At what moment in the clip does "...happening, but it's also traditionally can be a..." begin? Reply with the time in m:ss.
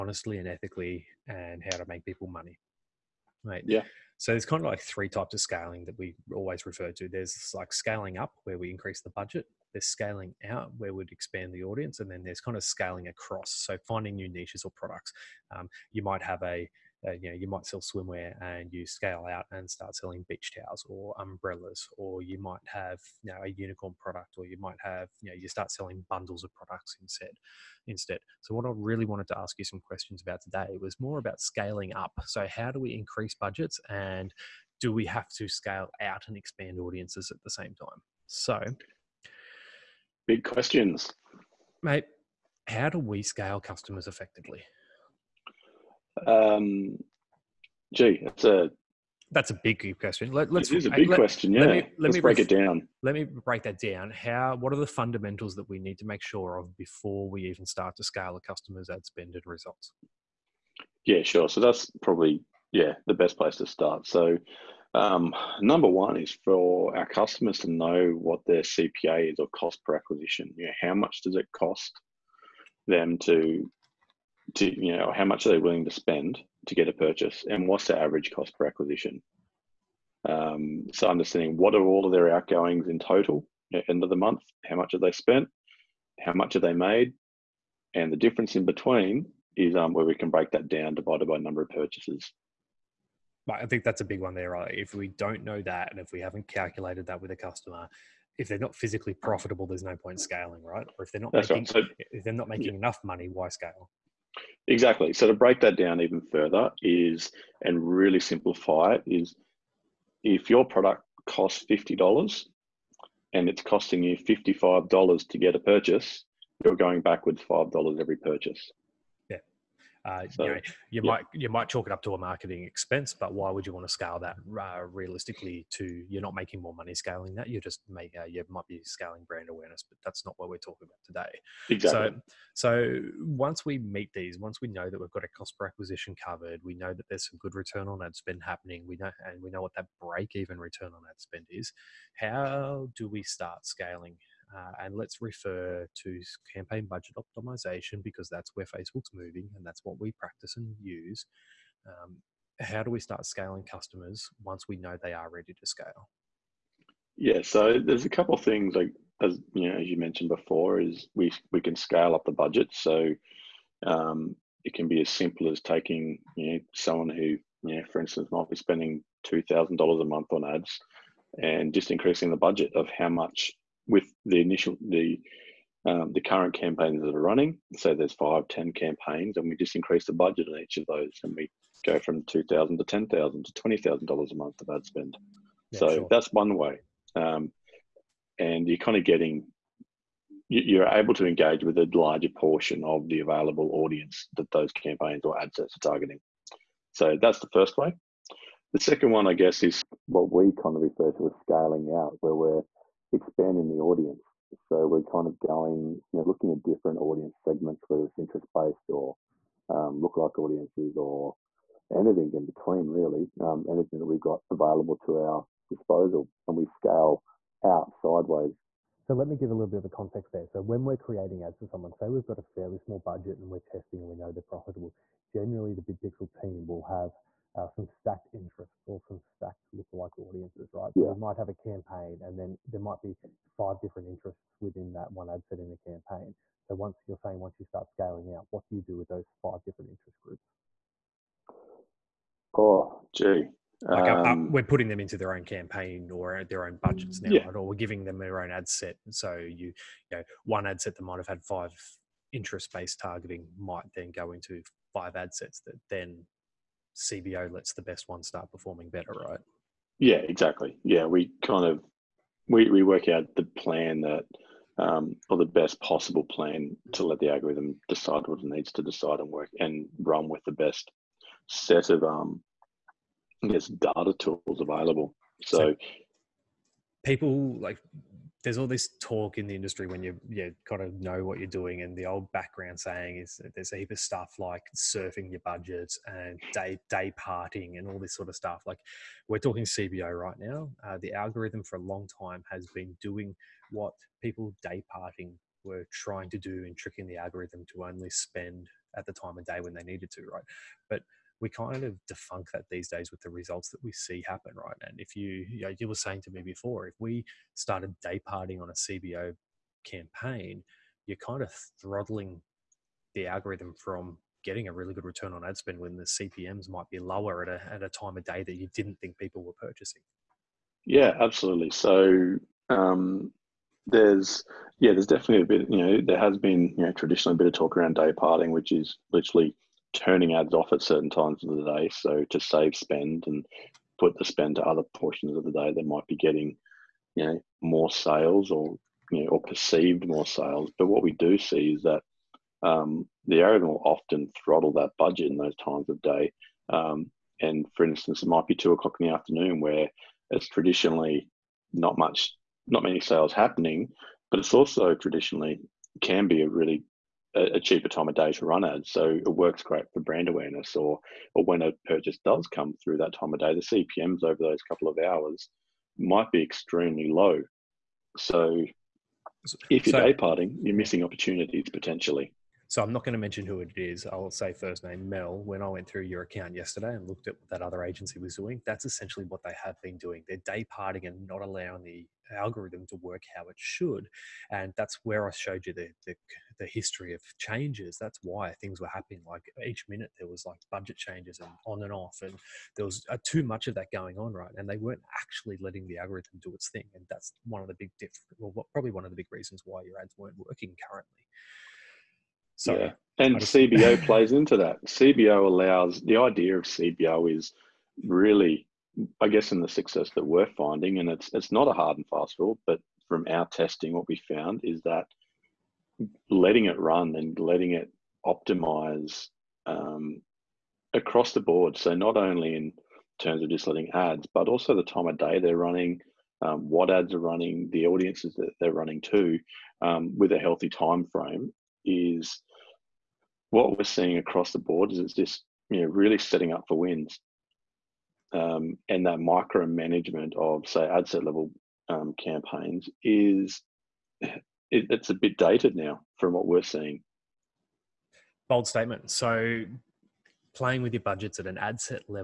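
5:53.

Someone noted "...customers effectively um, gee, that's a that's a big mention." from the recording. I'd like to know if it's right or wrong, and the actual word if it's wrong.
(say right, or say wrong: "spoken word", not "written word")
wrong: "question", not "mention".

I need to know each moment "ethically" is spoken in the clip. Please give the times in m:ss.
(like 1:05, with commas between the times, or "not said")
0:00.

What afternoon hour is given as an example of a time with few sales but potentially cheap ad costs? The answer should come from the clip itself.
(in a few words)
2 pm.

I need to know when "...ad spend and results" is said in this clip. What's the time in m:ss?
0:58.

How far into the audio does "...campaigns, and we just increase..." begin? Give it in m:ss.
2:58.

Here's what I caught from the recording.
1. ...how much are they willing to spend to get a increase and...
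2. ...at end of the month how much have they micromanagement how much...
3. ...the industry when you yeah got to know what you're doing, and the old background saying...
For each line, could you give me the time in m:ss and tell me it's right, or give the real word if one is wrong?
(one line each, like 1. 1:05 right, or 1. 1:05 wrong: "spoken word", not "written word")
1. 1:15 wrong: "purchase", not "increase"
2. 1:23 wrong: "spent", not "micromanagement"
3. 4:39 right.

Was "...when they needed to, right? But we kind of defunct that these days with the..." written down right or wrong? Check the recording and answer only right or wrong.
right.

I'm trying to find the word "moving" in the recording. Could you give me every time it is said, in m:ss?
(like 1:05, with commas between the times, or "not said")
2:29.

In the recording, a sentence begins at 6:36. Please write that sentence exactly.
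And that's one of the big diff- Well, what, probably one of the big reasons why your ads weren't working currently.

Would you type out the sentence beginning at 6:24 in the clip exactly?
And that's where I showed you the, the, the history of changes.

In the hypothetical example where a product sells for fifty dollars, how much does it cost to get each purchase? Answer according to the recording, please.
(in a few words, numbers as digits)
$55.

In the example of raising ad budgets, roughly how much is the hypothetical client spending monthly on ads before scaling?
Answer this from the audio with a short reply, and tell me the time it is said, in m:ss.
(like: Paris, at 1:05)
$2,000, at 2:49.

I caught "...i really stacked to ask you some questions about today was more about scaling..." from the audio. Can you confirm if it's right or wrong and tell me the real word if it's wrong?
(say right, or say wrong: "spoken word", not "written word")
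wrong: "wanted", not "stacked".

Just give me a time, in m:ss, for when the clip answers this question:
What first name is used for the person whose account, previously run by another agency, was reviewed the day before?
6:15.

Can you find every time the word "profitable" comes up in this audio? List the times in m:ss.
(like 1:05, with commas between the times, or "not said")
1:39, 3:44.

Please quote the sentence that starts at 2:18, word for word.
We know and we know what that break even return on ad spend is.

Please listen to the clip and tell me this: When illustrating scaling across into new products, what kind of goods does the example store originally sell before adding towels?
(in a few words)
Swimwear.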